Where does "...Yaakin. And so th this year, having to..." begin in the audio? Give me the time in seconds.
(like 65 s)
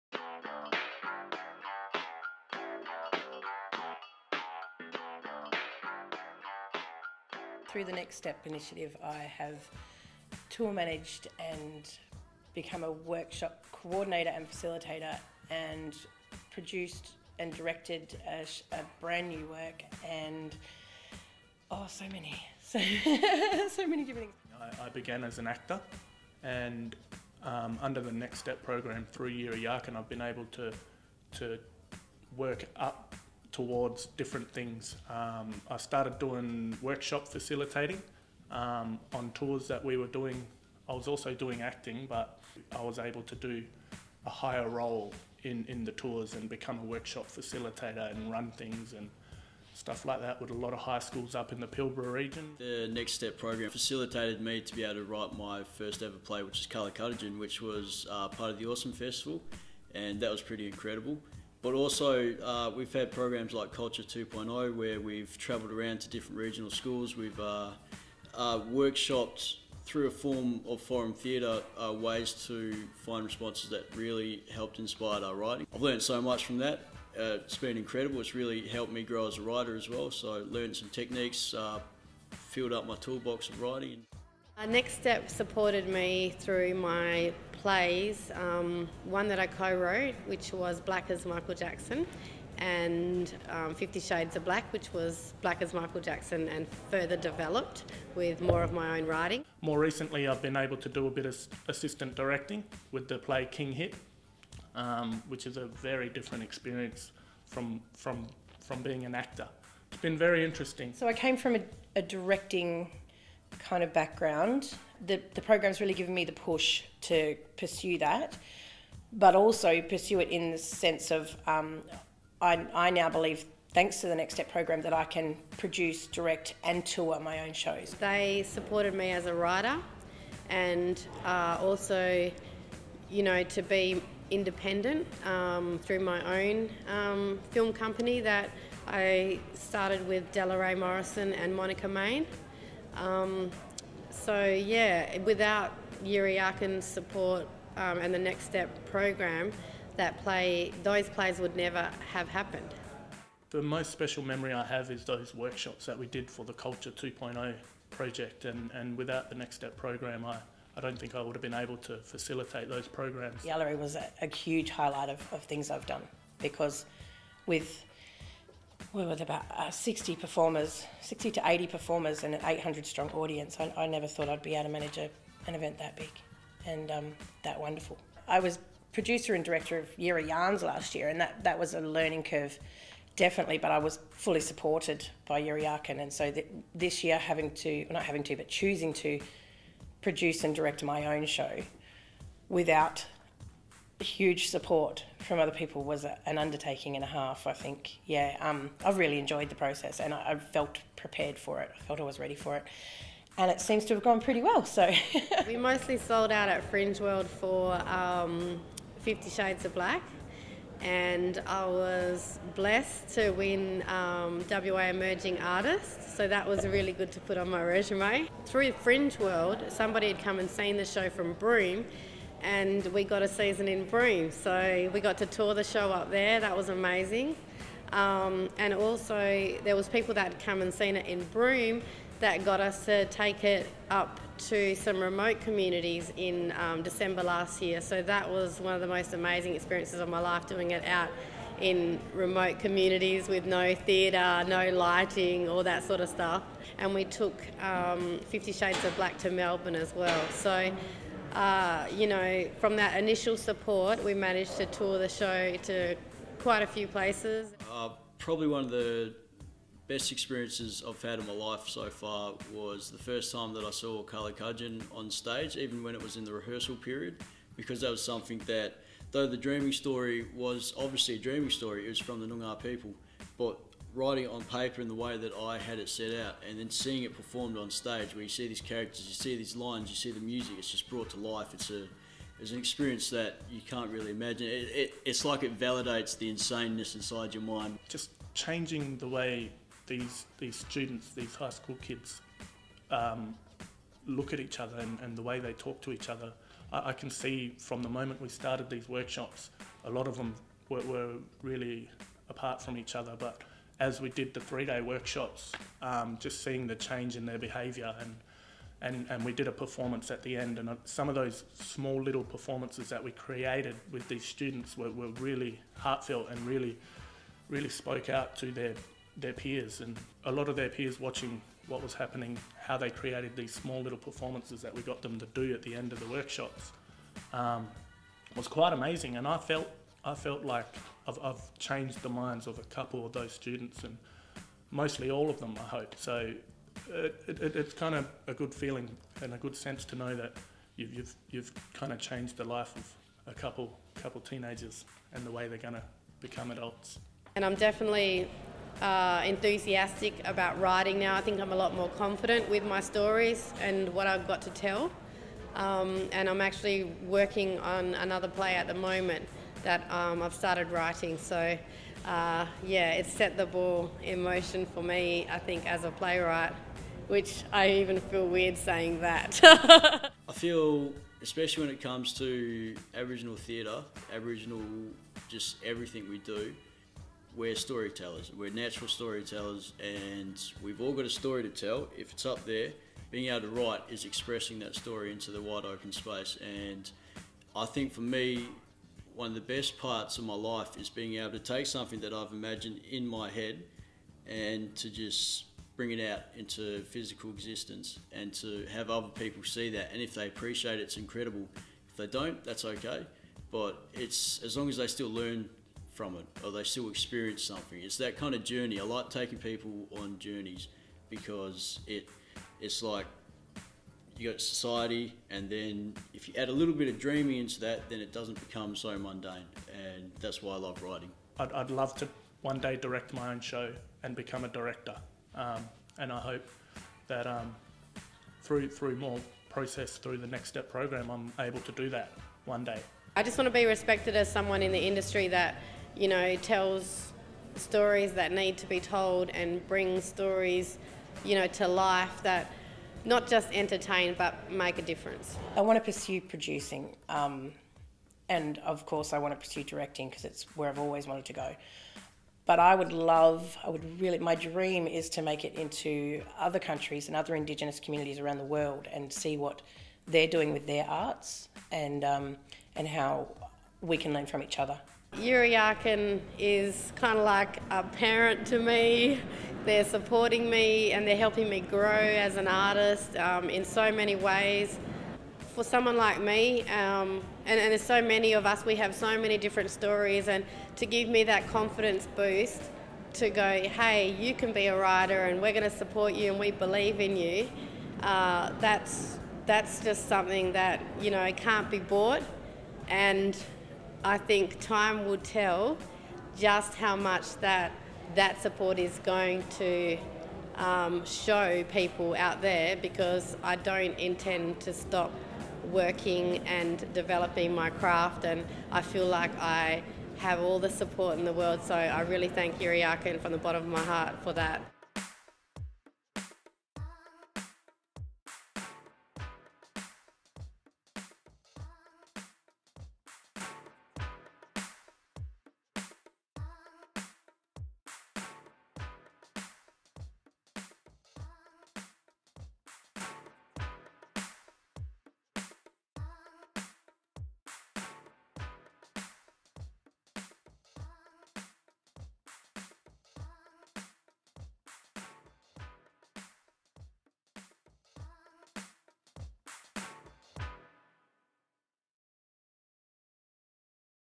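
185 s.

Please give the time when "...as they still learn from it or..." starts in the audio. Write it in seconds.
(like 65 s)
404 s.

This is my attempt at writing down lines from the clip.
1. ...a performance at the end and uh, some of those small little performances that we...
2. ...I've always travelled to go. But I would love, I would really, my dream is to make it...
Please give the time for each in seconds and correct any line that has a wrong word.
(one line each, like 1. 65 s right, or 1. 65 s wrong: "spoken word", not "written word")
1. 309 s right
2. 450 s wrong: "wanted", not "travelled".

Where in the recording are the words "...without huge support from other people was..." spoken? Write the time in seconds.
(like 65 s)
192 s.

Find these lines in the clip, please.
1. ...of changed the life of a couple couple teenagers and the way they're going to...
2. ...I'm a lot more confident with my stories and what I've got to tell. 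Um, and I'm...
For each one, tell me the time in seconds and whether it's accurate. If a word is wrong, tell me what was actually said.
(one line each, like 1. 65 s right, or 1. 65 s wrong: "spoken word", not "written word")
1. 341 s right
2. 351 s right.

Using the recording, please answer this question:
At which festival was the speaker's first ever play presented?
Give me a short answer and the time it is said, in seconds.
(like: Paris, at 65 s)
Awesome Festival, at 58 s.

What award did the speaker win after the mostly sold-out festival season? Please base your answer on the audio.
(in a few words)
WA Emerging Artist.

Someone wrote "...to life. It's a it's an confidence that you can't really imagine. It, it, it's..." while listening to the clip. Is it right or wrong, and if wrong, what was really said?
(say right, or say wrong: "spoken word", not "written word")
wrong: "experience", not "confidence".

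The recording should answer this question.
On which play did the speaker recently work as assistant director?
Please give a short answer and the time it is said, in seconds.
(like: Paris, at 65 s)
King Hit, at 103 s.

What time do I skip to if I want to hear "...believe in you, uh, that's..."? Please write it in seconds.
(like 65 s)
486 s.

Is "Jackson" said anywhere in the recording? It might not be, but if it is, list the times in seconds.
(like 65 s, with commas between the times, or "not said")
91 s, 96 s.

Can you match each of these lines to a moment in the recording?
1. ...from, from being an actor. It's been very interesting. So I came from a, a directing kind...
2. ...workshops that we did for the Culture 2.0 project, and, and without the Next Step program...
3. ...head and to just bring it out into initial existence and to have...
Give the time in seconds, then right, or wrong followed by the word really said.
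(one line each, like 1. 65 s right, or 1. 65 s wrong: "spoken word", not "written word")
1. 107 s right
2. 155 s right
3. 393 s wrong: "physical", not "initial".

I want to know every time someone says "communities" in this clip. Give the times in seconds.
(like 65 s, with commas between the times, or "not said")
235 s, 242 s, 457 s.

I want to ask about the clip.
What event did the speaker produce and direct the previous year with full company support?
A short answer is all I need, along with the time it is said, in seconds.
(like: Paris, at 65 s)
Year of Yarns, at 179 s.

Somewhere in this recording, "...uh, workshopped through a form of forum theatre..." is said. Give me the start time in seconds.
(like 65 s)
68 s.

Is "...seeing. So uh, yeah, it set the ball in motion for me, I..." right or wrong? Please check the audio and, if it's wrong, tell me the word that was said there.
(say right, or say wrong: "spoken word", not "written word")
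wrong: "writing", not "seeing".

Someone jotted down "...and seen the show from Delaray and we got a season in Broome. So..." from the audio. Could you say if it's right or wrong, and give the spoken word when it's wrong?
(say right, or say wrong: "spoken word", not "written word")
wrong: "Broome", not "Delaray".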